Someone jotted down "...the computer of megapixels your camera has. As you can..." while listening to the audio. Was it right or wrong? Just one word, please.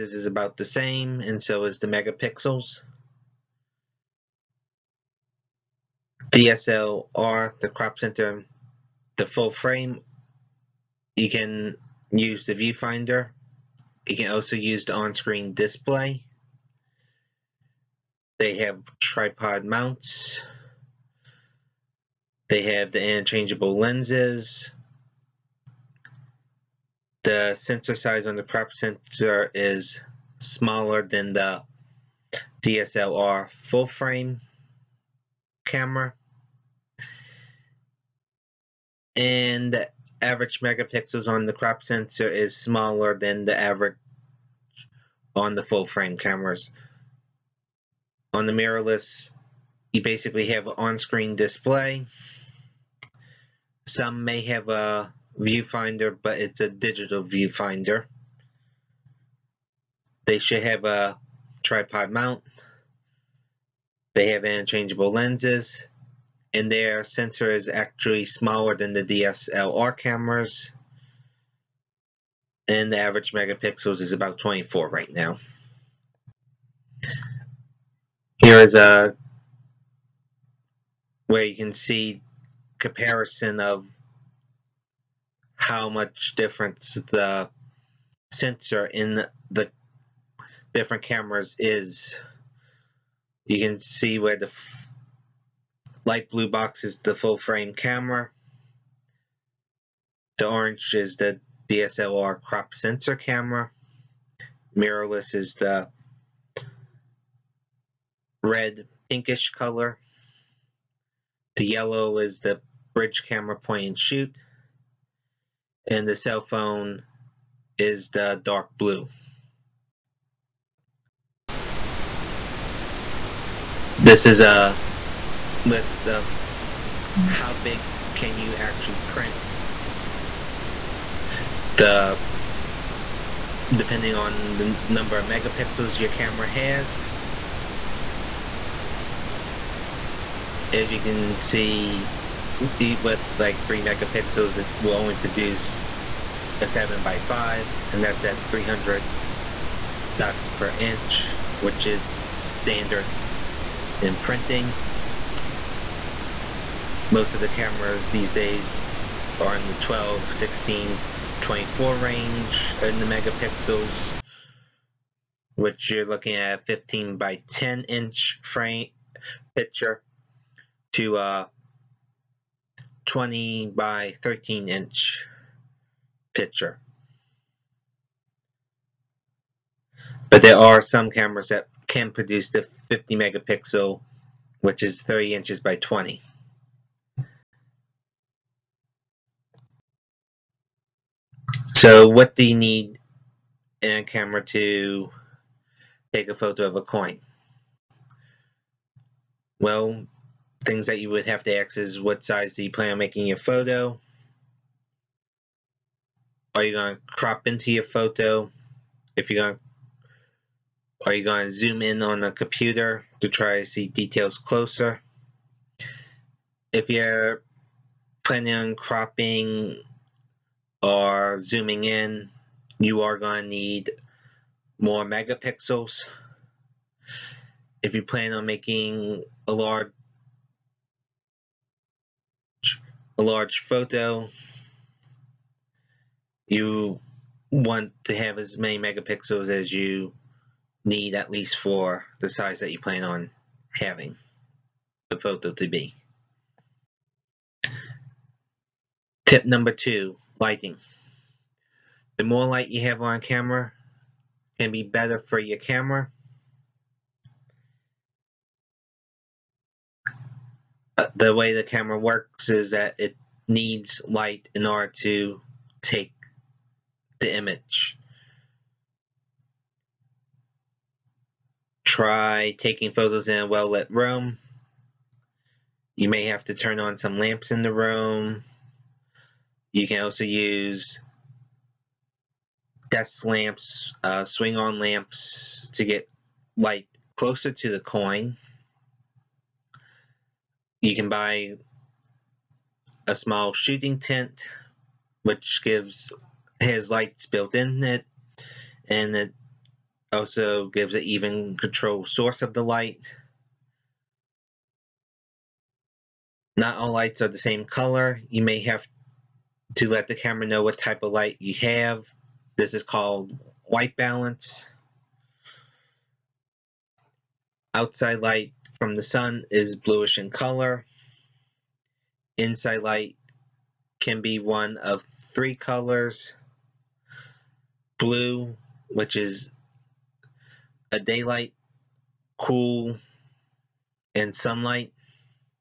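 wrong.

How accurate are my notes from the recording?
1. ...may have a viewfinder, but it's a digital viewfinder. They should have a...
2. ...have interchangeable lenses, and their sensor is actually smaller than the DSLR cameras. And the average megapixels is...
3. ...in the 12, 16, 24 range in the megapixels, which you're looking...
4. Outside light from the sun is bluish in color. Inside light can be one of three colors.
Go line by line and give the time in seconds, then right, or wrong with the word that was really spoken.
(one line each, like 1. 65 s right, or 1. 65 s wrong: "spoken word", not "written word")
1. 54 s right
2. 64 s right
3. 159 s right
4. 317 s right.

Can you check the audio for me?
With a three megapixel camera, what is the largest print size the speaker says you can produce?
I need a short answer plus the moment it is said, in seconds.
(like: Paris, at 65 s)
7 by 5, at 146 s.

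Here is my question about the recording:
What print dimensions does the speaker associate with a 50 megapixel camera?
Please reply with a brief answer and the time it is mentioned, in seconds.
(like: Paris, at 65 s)
30 by 20 inches, at 185 s.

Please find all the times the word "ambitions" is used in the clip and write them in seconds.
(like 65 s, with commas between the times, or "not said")
not said.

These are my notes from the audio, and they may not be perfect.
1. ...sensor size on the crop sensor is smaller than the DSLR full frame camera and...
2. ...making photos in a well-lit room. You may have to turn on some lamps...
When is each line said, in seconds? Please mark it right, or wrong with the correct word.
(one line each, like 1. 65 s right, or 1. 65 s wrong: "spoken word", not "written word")
1. 27 s right
2. 272 s wrong: "taking", not "making".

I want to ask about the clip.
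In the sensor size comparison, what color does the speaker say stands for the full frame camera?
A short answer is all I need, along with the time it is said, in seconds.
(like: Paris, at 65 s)
light blue, at 96 s.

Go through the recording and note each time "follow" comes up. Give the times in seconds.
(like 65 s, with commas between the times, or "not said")
not said.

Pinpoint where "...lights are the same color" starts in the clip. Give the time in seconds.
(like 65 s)
306 s.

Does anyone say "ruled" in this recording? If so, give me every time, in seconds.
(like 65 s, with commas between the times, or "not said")
not said.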